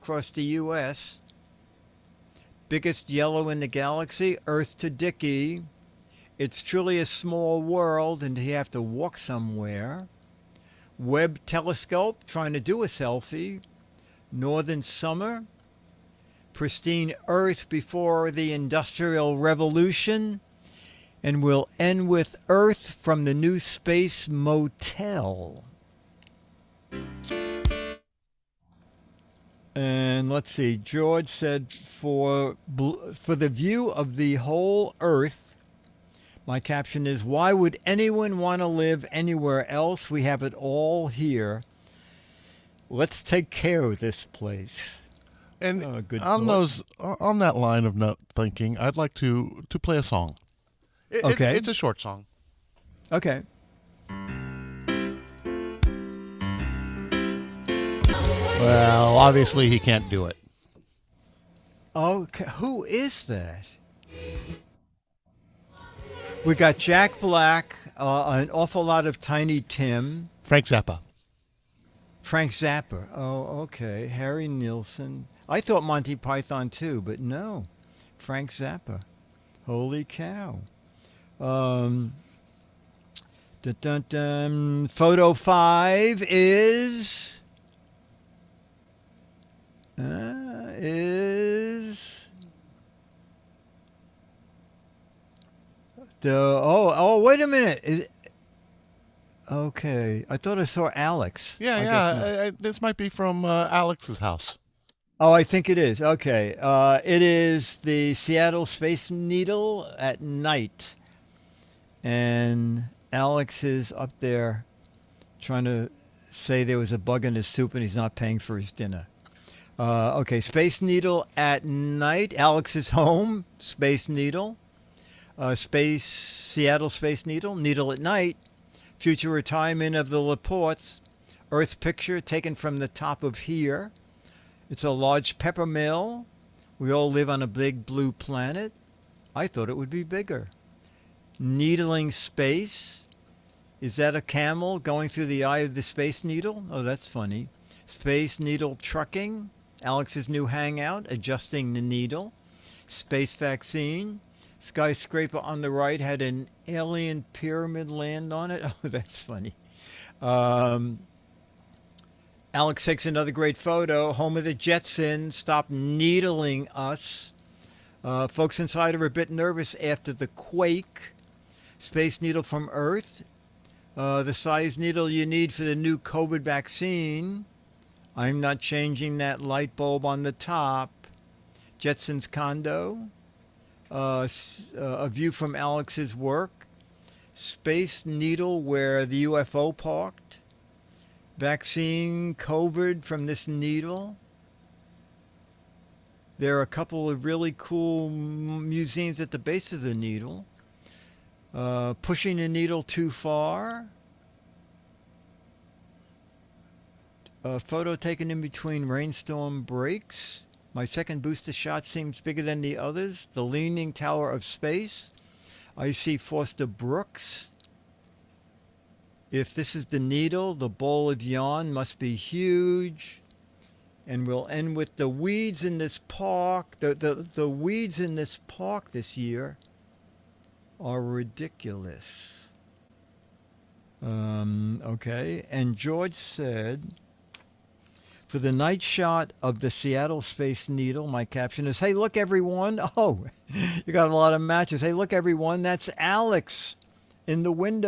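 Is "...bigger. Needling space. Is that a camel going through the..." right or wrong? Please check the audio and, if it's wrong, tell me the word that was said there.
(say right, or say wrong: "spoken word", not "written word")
right.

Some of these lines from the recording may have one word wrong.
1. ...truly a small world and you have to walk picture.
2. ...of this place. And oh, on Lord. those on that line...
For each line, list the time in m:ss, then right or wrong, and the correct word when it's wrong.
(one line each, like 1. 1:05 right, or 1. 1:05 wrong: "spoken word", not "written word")
1. 0:06 wrong: "somewhere", not "picture"
2. 0:43 right.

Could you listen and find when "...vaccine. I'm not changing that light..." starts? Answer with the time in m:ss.
2:56.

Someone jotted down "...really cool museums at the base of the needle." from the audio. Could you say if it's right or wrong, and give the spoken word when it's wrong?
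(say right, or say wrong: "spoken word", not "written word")
right.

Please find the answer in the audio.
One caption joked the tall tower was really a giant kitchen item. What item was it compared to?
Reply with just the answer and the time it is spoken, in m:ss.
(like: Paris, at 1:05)
A large pepper mill, at 2:14.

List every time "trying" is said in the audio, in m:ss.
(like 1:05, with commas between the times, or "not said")
0:12, 1:55.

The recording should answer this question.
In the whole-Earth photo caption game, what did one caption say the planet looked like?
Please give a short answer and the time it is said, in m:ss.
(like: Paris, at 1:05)
Pristine Earth before the Industrial Revolution, at 0:16.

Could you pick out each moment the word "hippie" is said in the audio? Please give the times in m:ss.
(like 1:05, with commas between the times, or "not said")
not said.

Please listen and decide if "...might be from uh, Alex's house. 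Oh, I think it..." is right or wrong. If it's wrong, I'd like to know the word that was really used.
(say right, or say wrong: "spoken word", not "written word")
right.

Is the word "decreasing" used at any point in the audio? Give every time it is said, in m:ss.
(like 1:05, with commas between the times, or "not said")
not said.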